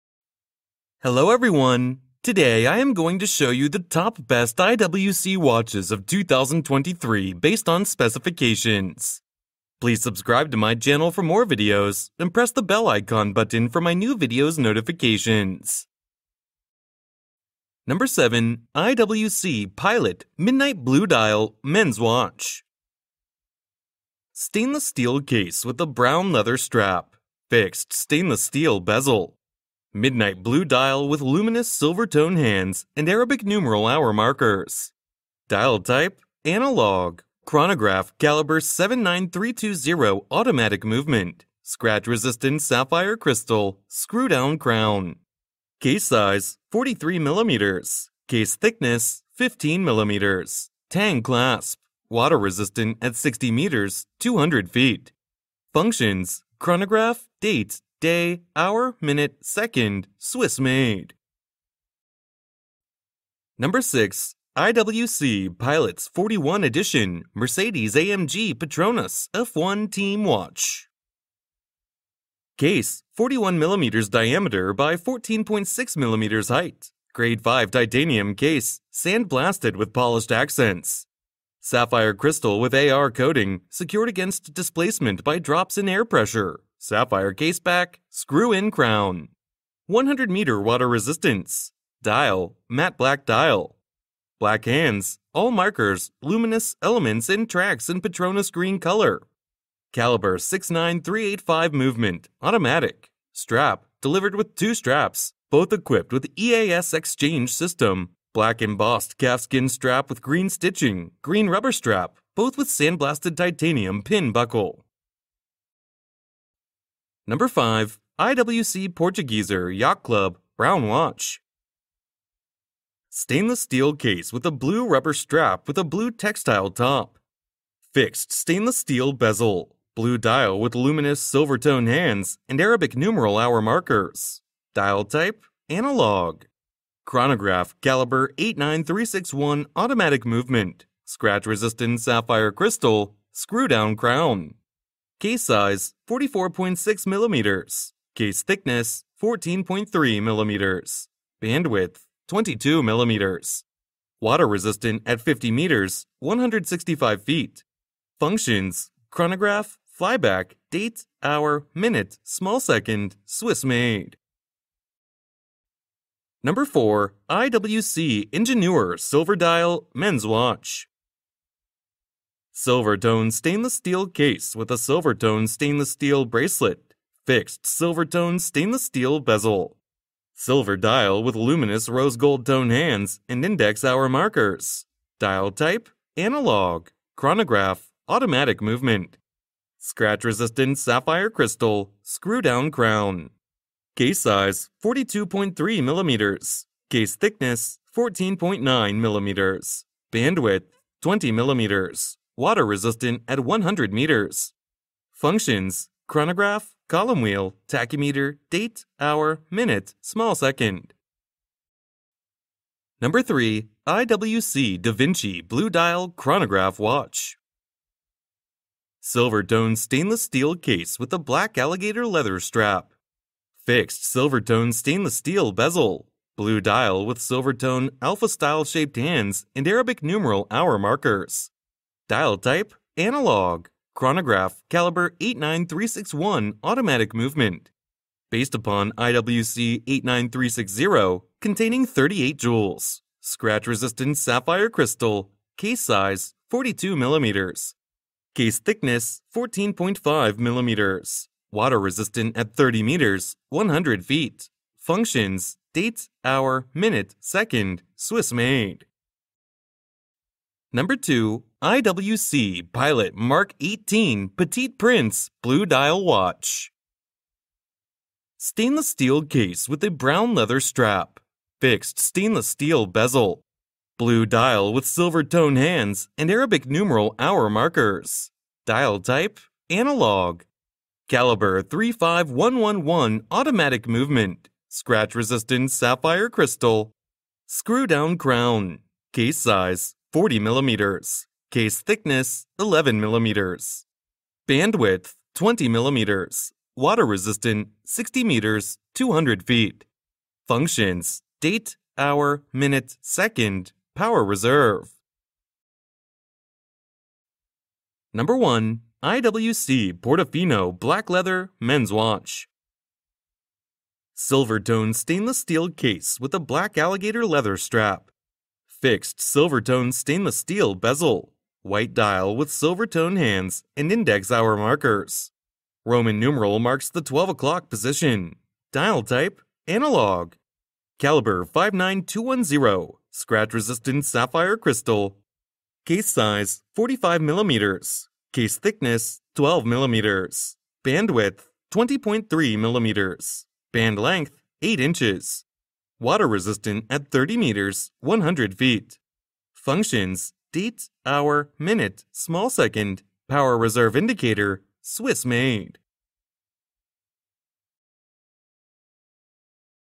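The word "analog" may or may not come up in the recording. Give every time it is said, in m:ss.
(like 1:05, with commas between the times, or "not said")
0:36, 2:15, 3:06, 3:52, 4:39, 5:29.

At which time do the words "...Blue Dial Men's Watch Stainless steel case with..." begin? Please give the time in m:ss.
0:20.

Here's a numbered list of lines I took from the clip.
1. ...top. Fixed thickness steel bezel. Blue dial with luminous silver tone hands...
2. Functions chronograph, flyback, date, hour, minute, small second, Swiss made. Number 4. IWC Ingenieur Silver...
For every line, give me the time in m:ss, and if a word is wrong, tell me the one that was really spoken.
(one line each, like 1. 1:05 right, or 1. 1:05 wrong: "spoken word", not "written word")
1. 2:06 wrong: "stainless", not "thickness"
2. 2:38 right.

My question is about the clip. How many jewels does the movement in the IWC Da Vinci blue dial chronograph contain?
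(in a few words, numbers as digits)
38.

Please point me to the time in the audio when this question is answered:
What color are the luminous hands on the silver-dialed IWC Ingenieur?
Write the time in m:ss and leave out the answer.
3:01.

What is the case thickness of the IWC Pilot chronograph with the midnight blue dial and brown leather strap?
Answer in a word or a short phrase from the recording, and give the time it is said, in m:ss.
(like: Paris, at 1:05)
15 mm, at 0:49.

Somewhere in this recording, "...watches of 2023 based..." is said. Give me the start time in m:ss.
0:05.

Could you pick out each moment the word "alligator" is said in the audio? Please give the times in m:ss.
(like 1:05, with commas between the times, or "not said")
3:41, 5:16.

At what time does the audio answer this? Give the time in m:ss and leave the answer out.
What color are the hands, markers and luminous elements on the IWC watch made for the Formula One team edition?
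1:38.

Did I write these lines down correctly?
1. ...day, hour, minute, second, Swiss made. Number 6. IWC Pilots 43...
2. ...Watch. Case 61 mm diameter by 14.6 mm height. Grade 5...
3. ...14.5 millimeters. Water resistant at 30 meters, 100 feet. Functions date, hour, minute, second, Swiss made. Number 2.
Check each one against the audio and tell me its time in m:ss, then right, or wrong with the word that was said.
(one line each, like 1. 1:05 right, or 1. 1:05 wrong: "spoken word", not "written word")
1. 0:58 wrong: "41", not "43"
2. 1:10 wrong: "41", not "61"
3. 4:09 right.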